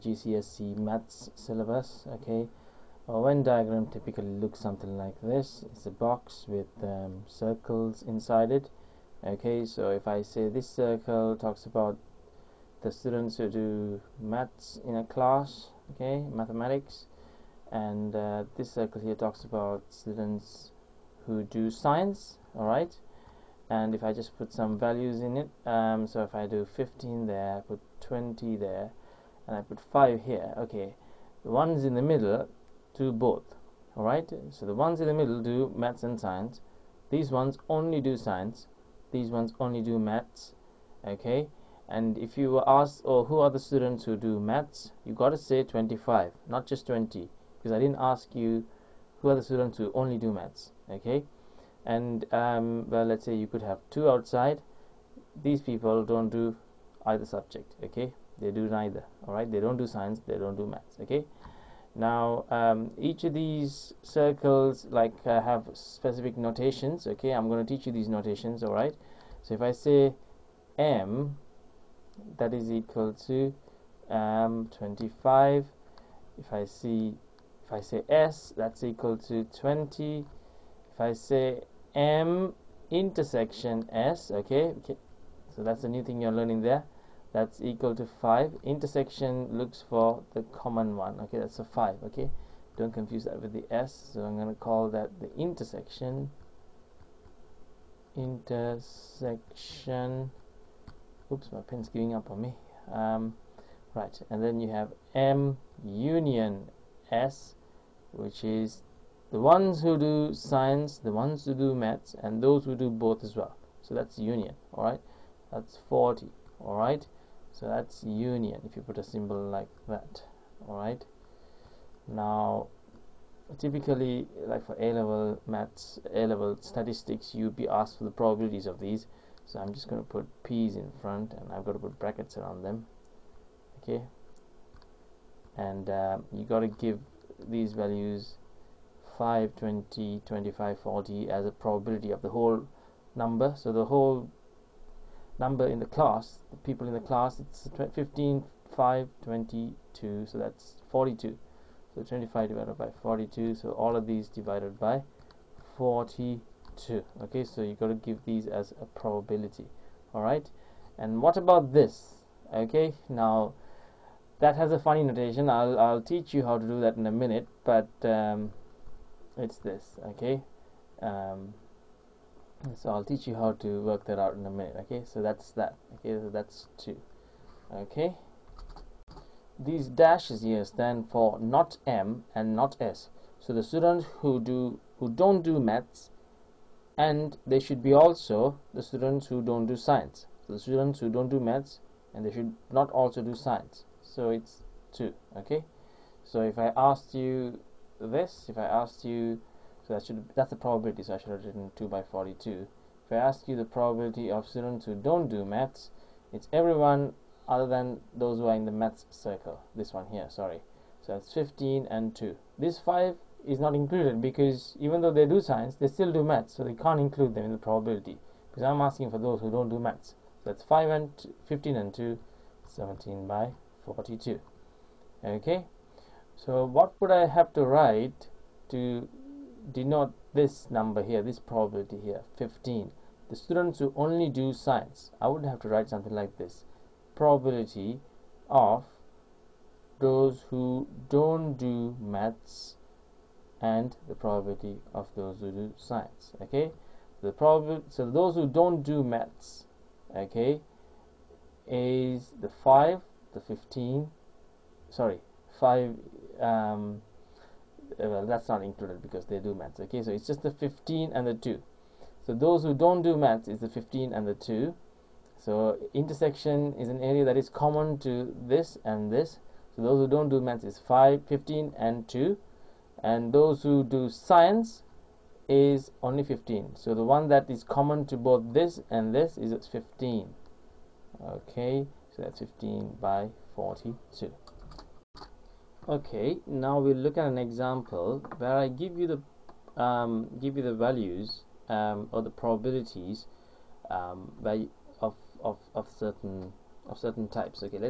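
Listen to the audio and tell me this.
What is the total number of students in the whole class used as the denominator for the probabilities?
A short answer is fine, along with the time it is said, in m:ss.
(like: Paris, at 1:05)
42, at 2:30.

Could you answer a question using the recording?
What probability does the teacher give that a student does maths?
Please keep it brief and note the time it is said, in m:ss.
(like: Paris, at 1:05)
17/42, at 3:42.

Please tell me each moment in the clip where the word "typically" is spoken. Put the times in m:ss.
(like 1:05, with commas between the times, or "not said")
0:03, 2:03.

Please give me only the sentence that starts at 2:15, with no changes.
And uh, you got to give these values 5, 20, 25, 40 as a probability of the whole number.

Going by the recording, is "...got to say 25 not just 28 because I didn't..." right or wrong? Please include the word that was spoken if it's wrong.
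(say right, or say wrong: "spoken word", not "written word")
wrong: "20", not "28".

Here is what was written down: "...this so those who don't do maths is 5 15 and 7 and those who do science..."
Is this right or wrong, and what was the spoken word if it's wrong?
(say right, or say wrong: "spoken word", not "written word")
wrong: "2", not "7".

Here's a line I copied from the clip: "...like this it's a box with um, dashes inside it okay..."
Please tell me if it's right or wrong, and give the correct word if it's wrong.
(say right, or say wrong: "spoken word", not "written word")
wrong: "circles", not "dashes".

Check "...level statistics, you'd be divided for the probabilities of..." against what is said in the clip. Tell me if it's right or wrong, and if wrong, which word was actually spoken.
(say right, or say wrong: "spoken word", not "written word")
wrong: "asked", not "divided".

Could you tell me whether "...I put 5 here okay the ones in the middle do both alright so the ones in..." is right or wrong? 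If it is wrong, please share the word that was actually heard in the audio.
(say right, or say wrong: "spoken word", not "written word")
right.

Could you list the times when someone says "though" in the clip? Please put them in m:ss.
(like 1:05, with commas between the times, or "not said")
3:35.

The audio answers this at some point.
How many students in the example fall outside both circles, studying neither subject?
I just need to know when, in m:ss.
3:14.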